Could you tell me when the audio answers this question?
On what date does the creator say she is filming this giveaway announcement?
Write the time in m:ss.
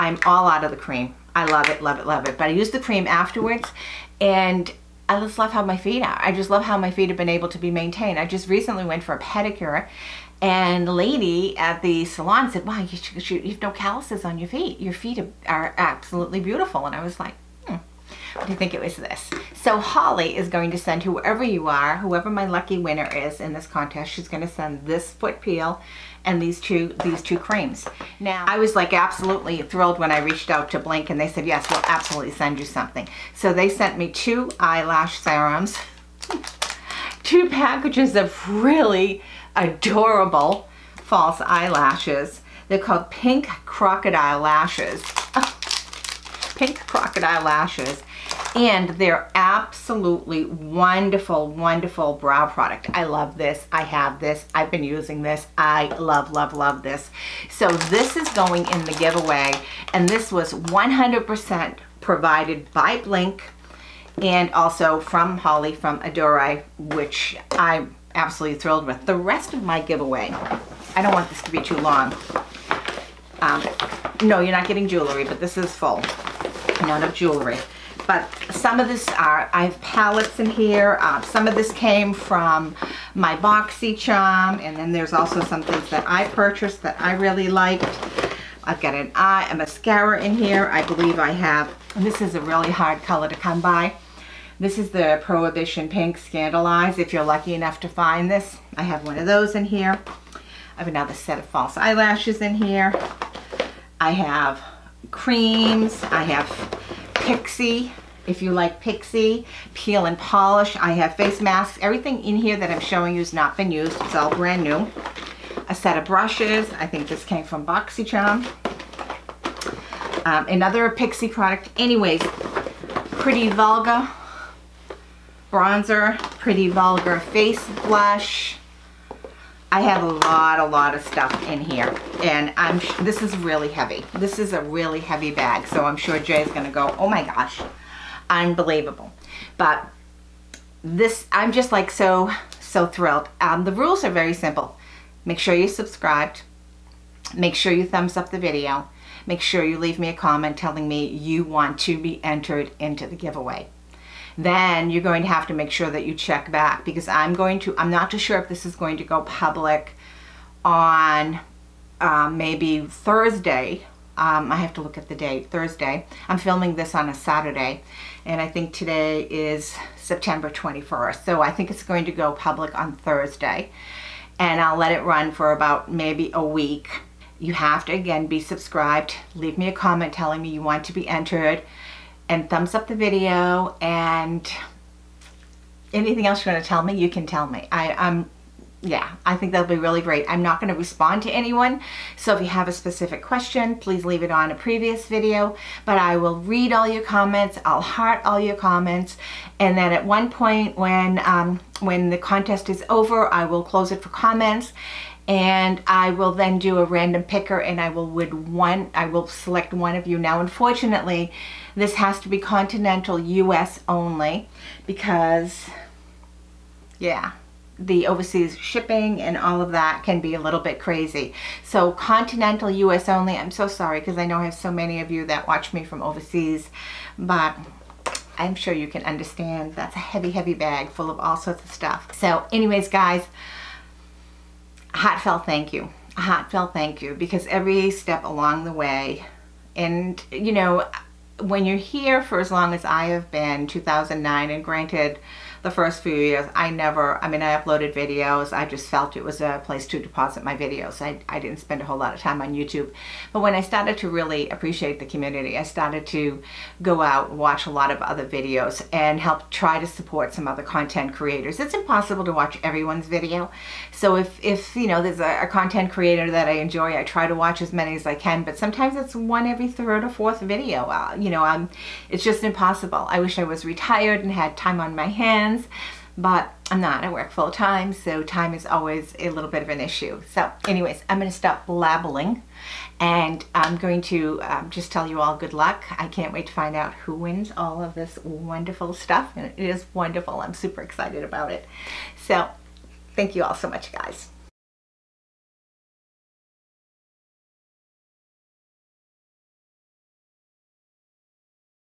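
2:49.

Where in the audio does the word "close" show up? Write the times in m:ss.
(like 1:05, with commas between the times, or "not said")
3:23.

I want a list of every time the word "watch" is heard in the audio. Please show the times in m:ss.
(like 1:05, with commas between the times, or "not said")
3:45, 4:17, 4:22, 4:27.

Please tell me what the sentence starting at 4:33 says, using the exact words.
I wish I was retired and had time on my hands but I'm not.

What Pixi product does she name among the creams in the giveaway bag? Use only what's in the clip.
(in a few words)
Peel and Polish.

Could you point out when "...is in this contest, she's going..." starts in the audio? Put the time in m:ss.
0:23.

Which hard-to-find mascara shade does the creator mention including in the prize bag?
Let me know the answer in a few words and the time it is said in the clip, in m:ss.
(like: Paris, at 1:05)
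Prohibition Pink, at 1:35.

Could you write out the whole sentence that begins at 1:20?
Uh, some of this came from my BoxyCharm, and then there's also some things that I purchased that I really liked.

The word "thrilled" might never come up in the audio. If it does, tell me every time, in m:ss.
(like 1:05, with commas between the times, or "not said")
0:29, 1:08, 2:22.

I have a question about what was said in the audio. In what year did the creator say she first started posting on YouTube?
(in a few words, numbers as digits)
2009.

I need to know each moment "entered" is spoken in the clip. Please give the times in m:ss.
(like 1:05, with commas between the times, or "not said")
2:32, 3:01.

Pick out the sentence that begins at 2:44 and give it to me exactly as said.
Um, I have to look at the date, Thursday.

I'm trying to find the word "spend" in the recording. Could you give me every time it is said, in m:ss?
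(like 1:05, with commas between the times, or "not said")
4:11.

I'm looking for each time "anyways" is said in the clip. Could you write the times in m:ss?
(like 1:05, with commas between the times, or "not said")
2:01, 3:52, 4:40.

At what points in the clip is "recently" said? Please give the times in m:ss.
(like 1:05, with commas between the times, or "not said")
0:08.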